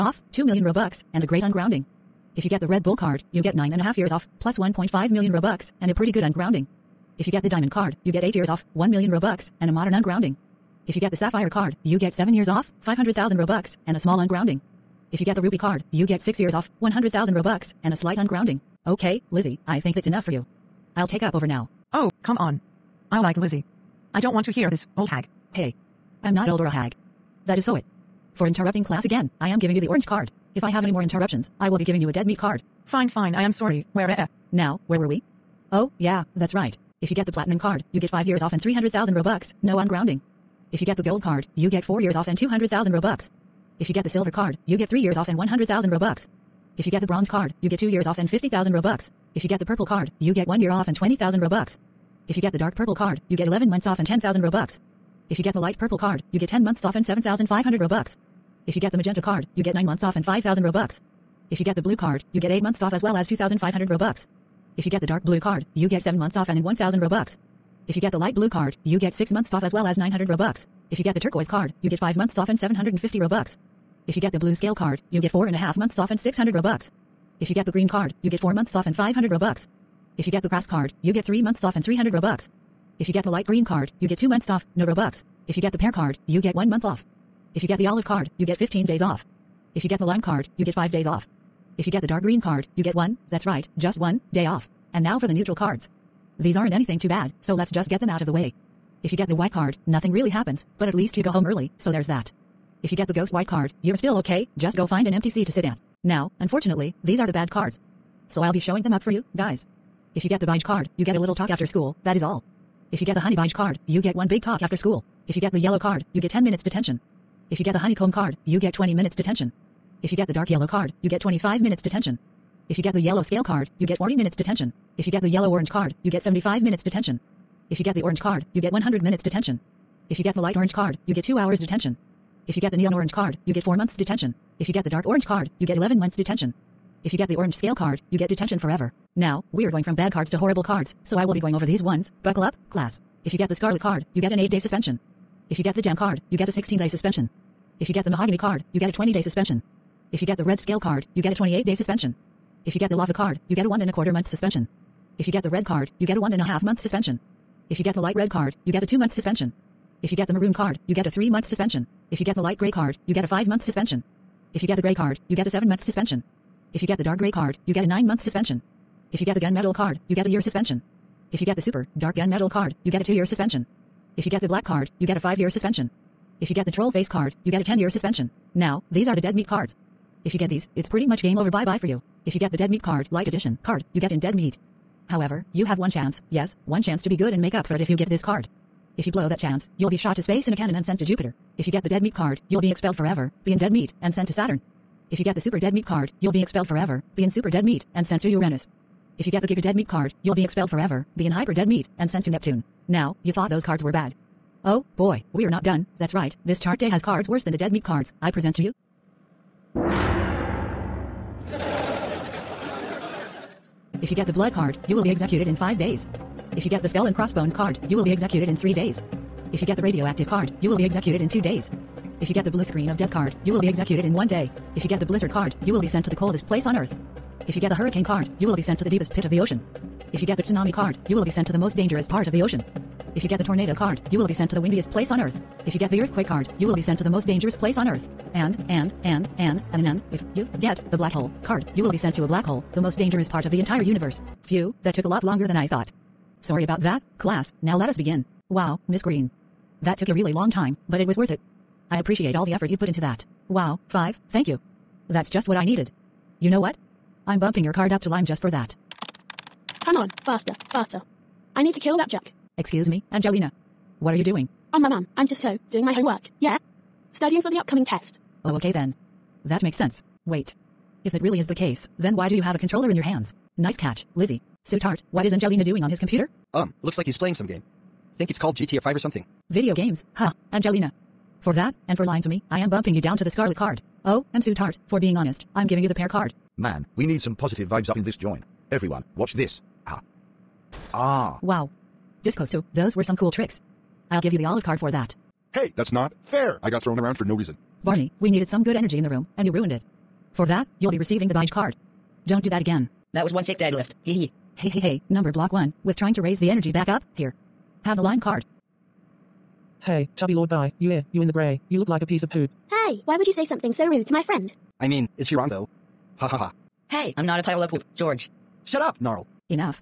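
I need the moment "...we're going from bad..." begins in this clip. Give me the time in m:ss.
2:19.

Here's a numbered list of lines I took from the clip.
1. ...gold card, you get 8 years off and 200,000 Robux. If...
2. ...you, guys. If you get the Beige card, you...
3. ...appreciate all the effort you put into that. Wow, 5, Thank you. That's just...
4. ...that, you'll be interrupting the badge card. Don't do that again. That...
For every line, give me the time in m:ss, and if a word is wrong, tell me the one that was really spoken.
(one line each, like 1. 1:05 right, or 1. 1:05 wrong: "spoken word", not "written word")
1. 0:41 wrong: "4", not "8"
2. 1:49 right
3. 4:11 right
4. 5:00 wrong: "receiving", not "interrupting".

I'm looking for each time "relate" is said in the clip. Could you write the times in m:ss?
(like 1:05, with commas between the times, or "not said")
not said.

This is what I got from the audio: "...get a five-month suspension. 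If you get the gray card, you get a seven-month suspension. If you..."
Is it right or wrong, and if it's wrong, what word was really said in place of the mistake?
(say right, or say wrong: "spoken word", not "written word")
right.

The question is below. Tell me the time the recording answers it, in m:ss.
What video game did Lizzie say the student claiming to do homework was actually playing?
4:38.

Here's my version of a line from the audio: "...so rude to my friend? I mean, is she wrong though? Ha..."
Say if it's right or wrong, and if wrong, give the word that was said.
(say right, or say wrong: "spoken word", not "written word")
right.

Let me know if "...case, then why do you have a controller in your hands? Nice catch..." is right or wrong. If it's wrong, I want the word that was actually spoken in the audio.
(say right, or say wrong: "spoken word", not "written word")
right.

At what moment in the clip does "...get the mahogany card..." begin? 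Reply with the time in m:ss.
2:27.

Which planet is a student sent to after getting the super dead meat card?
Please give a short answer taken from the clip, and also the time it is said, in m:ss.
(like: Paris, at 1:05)
Uranus, at 3:18.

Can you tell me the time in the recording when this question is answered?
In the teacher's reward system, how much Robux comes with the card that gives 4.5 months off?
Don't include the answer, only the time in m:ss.
1:16.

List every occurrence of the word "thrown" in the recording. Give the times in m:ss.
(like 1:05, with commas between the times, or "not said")
4:56.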